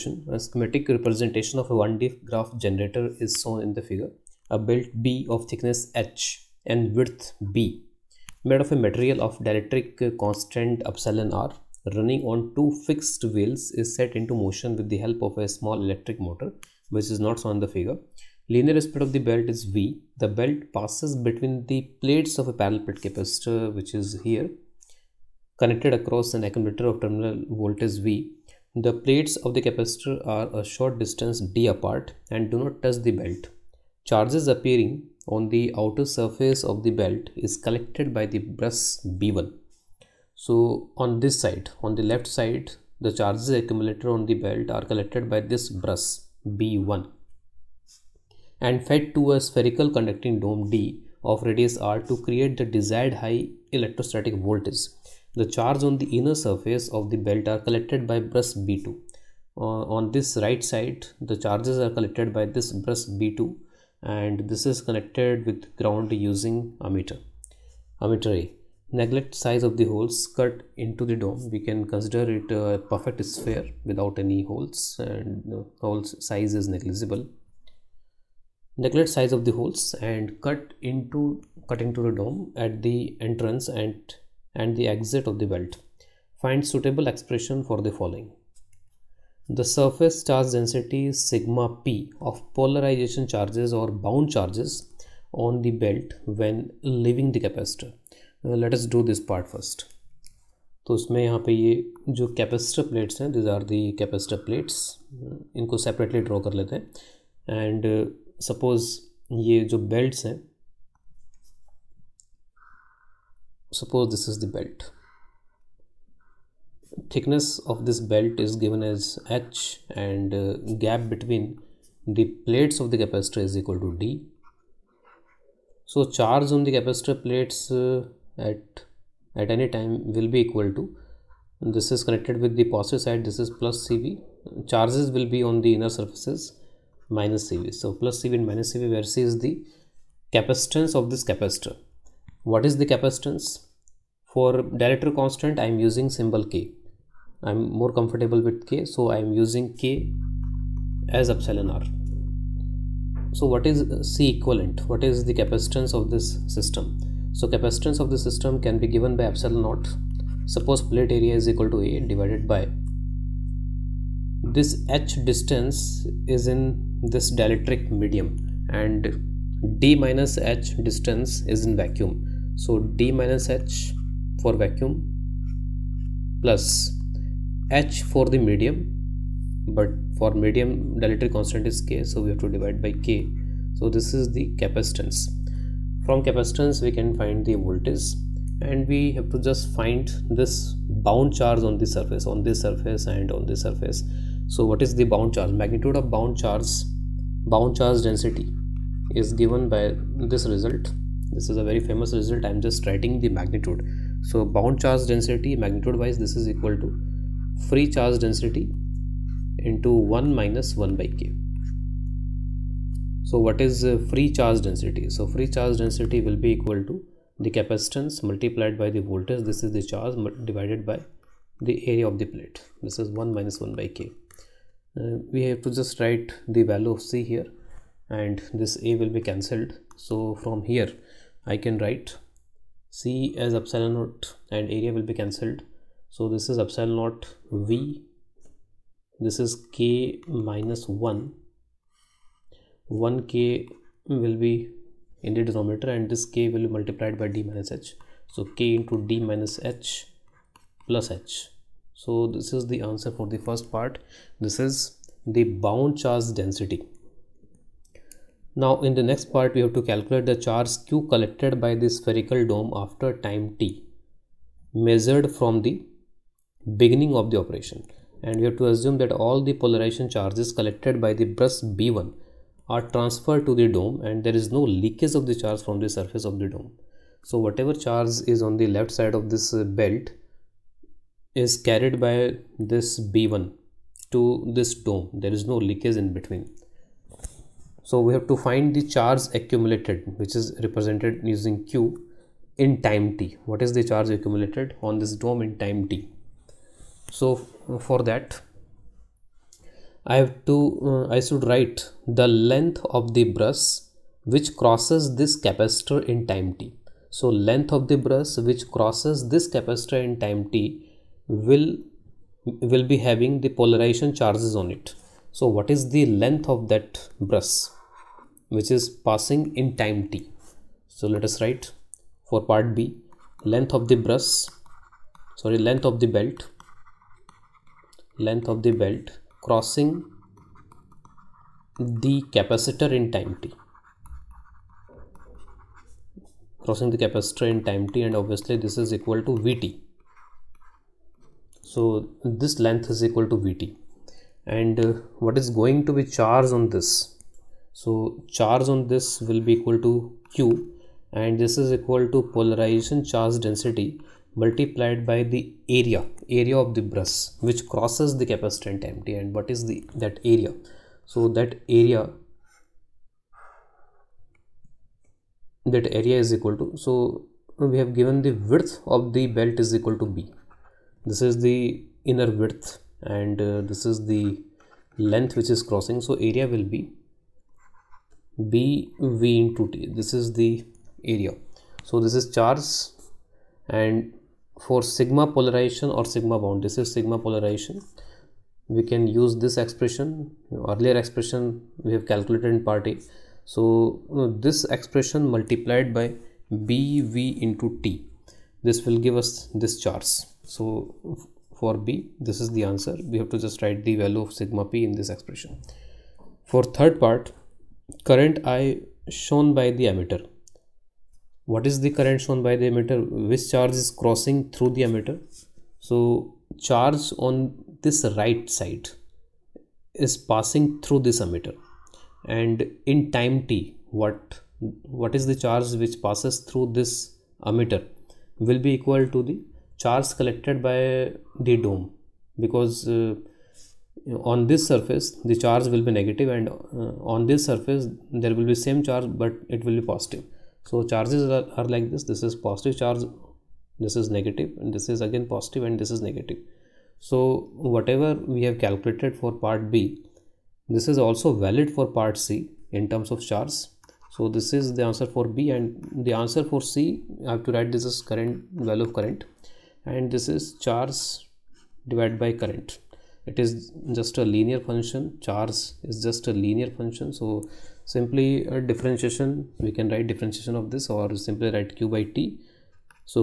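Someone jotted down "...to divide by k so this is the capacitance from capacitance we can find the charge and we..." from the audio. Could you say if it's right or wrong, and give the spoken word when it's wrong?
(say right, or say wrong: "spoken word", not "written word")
wrong: "voltage", not "charge".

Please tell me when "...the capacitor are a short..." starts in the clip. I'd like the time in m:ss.
0:29.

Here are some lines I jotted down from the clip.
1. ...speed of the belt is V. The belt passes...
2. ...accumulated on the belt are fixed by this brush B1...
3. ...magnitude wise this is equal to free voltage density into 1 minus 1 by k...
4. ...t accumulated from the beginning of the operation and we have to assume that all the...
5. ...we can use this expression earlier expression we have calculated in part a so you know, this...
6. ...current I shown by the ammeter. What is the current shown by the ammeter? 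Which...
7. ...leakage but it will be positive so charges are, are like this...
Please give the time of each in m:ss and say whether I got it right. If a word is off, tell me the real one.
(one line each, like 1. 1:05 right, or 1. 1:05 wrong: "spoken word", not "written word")
1. 0:18 right
2. 0:43 wrong: "collected", not "fixed"
3. 3:25 wrong: "charge", not "voltage"
4. 4:23 wrong: "measured", not "accumulated"
5. 6:28 right
6. 6:48 right
7. 7:18 wrong: "charge", not "leakage".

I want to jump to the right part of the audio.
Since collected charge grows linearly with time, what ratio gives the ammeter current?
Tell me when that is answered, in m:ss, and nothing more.
7:51.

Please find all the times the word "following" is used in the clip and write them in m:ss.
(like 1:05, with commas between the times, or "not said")
1:27.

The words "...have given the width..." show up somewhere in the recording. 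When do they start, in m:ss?
6:07.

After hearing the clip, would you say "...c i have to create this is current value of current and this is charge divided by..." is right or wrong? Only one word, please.
wrong.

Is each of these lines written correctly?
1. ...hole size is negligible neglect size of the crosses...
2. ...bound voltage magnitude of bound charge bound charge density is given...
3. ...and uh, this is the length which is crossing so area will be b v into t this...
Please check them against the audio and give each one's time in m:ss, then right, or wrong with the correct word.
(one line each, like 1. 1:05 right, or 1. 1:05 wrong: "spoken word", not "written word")
1. 1:15 wrong: "holes", not "crosses"
2. 3:15 wrong: "charge", not "voltage"
3. 6:13 right.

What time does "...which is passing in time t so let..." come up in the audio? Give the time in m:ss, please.
5:18.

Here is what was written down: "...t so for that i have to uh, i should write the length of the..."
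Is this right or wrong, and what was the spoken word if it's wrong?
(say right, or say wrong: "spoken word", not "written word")
right.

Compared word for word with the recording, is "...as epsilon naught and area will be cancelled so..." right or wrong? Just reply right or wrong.
right.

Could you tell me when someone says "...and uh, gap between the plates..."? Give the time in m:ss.
2:00.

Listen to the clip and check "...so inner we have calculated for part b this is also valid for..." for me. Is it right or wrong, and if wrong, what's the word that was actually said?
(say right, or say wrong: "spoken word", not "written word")
wrong: "whatever", not "inner".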